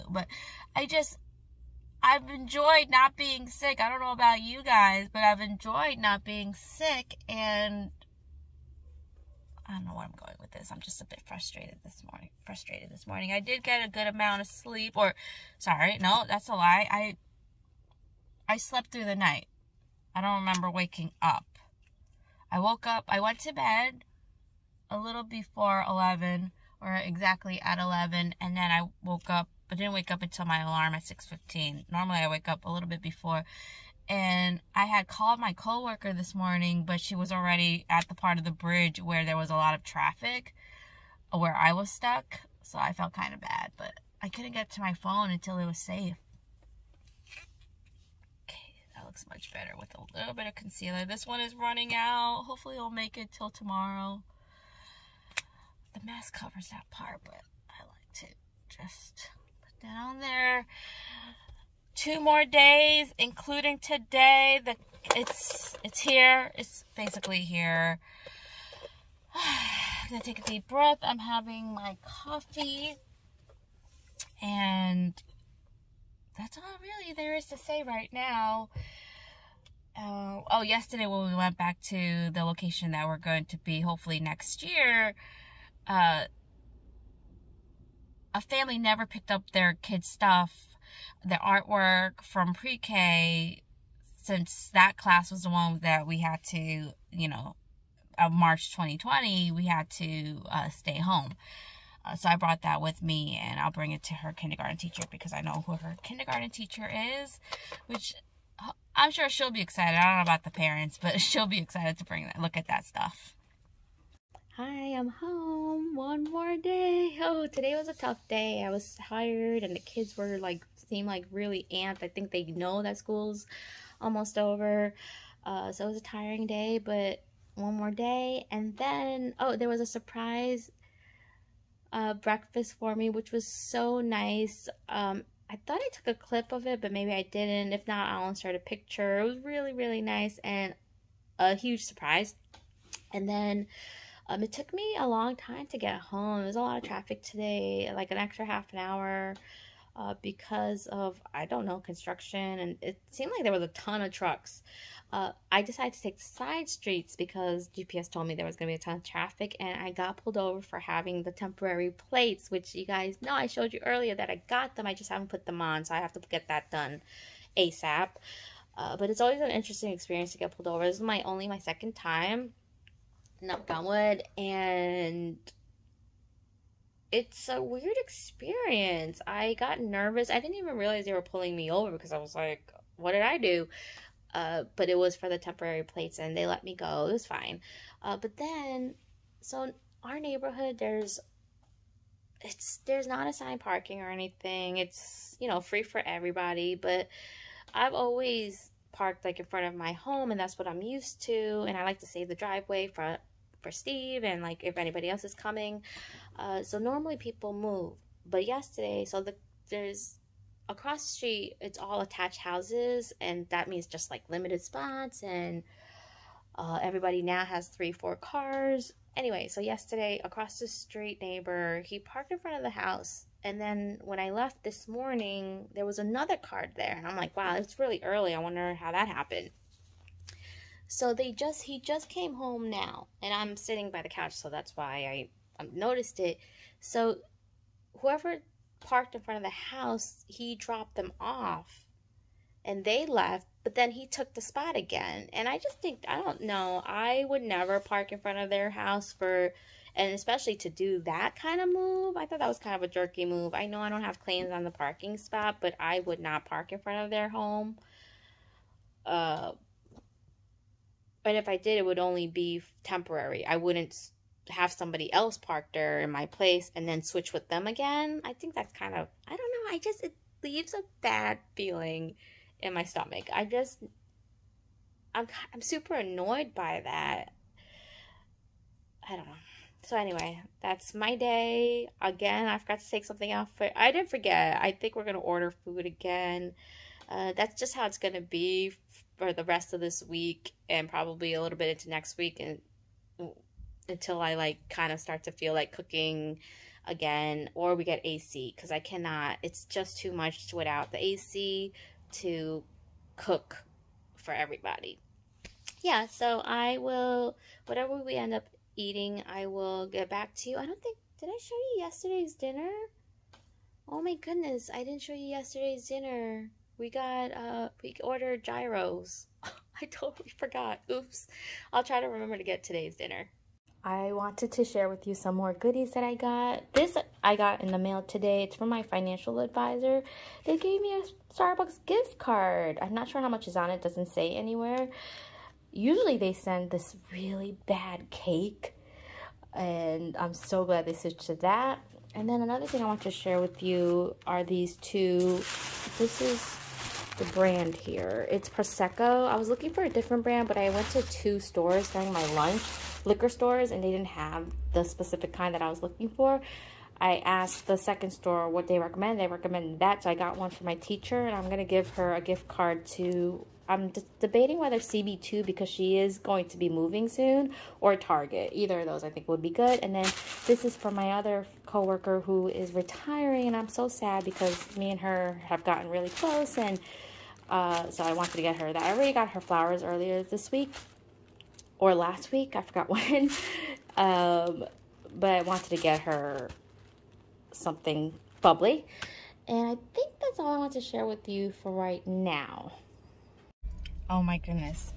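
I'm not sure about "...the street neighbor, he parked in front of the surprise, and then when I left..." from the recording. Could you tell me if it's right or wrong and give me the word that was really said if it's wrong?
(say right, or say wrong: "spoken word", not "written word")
wrong: "house", not "surprise".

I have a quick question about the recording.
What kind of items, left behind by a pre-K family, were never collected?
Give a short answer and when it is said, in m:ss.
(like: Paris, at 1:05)
artwork, at 1:31.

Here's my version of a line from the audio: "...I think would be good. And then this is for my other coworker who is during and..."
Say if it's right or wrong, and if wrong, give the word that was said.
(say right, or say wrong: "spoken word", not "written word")
wrong: "retiring", not "during".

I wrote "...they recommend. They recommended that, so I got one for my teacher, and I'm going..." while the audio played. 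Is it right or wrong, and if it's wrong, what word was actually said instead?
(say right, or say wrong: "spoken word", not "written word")
right.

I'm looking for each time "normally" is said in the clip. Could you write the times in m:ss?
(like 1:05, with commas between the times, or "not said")
0:31, 3:26.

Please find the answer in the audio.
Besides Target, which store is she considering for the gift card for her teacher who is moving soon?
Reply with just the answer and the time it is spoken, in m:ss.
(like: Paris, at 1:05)
CB2, at 6:04.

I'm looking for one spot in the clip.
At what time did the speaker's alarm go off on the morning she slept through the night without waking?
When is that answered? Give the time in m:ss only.
0:31.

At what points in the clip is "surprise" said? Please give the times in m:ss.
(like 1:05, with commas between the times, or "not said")
2:09, 2:21.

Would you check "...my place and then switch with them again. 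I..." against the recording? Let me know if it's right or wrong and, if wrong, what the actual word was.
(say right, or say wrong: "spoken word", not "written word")
right.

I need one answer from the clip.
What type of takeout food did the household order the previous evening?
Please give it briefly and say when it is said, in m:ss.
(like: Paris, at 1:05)
gyros, at 5:18.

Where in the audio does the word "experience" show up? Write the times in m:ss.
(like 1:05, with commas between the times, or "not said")
2:49, 2:57.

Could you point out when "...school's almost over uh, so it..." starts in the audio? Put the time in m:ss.
2:02.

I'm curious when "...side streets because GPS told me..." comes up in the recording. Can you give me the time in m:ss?
2:36.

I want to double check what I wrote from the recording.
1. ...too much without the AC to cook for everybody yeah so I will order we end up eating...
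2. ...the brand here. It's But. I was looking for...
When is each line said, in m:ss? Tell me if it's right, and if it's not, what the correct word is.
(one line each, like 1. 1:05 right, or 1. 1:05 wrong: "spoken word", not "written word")
1. 4:59 wrong: "whatever", not "order"
2. 5:47 wrong: "Prosecco", not "But".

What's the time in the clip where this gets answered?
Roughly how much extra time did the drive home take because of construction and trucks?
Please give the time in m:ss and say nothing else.
2:28.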